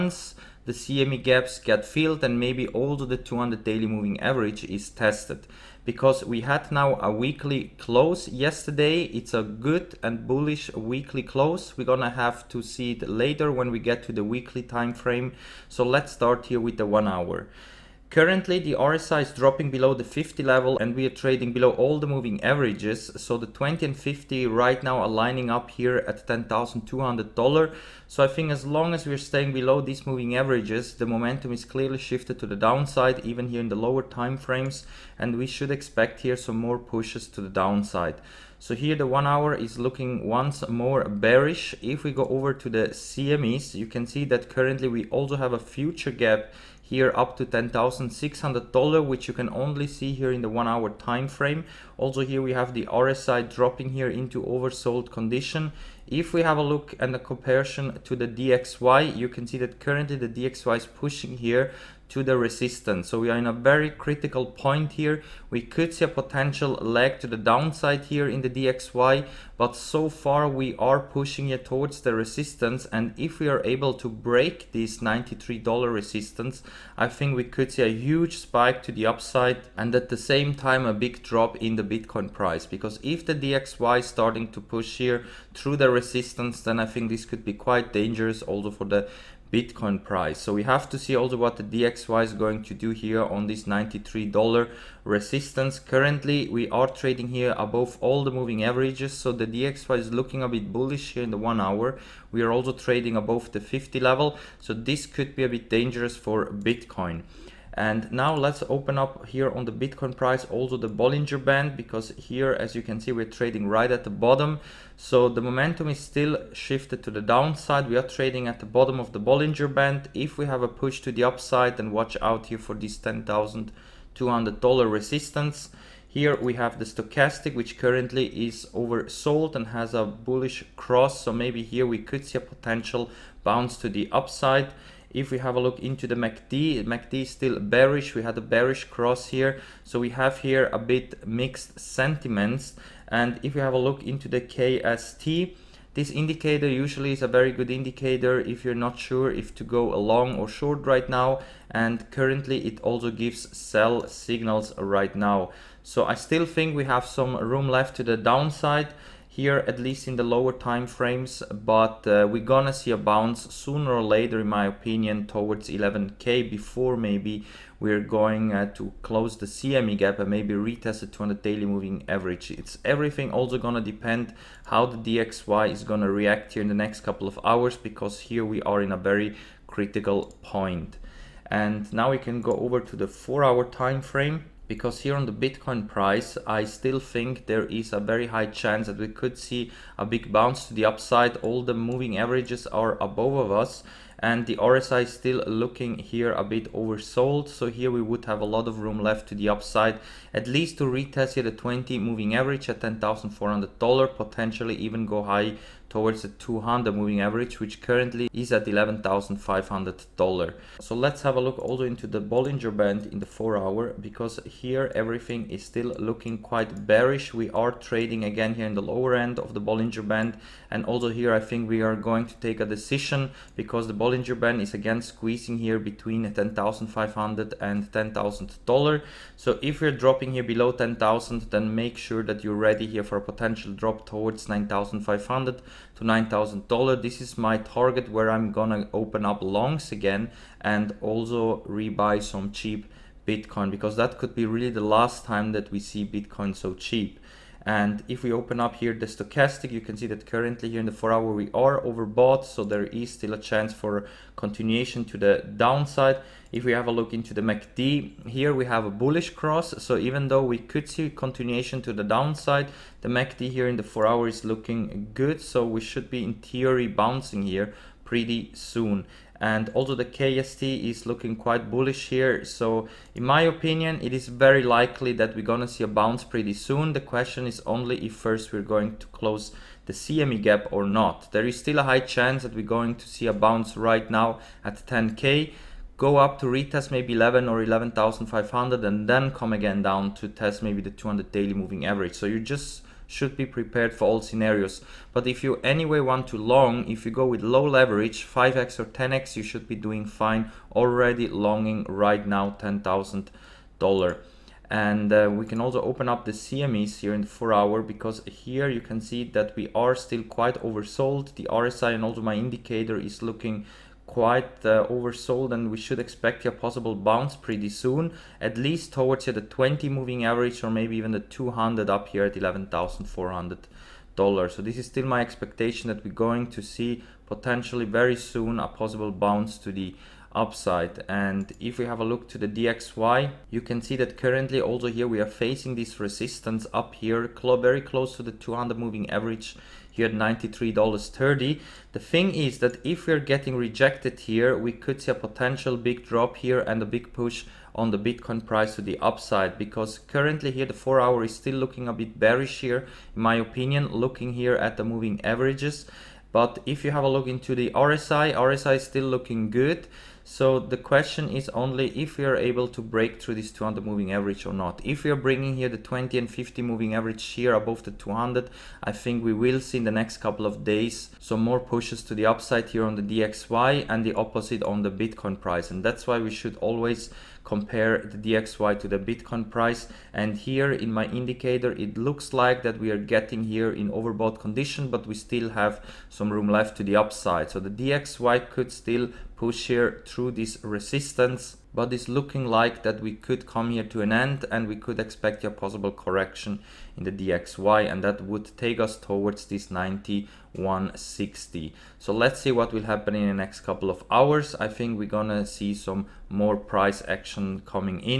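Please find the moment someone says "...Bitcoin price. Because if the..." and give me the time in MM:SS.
01:21.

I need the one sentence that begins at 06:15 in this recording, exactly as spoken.
And that's why we should always compare the DXY to the Bitcoin price.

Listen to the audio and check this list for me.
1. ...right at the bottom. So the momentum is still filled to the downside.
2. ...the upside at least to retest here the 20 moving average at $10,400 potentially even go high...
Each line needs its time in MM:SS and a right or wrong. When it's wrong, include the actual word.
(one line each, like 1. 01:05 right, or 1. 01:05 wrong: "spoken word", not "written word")
1. 01:53 wrong: "shifted", not "filled"
2. 03:19 right.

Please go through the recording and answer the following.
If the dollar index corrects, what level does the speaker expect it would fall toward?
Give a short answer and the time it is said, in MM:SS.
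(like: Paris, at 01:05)
91.60, at 06:39.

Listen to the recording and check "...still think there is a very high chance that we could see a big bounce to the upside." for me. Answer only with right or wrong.
right.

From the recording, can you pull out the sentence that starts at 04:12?
So there is still a chance for continuation to the downside.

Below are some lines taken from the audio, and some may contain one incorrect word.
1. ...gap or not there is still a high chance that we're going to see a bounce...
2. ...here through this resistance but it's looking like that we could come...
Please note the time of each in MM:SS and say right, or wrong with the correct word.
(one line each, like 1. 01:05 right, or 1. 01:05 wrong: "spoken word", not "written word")
1. 04:40 right
2. 06:29 right.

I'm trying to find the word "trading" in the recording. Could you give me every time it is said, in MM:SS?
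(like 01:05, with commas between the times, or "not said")
00:21, 01:36, 01:42, 01:53, 01:58, 03:37.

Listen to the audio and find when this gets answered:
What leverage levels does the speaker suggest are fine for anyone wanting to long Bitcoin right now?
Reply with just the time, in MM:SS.
04:58.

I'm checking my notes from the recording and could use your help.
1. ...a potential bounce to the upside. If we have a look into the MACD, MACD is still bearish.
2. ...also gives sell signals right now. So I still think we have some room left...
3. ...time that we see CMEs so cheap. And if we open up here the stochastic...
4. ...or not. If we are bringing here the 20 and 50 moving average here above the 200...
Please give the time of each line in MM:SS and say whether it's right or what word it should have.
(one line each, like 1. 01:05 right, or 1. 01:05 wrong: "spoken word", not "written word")
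1. 02:12 right
2. 02:32 right
3. 04:05 wrong: "Bitcoin", not "CMEs"
4. 06:04 right.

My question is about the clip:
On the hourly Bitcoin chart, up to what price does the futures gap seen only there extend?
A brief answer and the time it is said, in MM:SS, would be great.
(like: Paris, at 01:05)
$10,600, at 00:47.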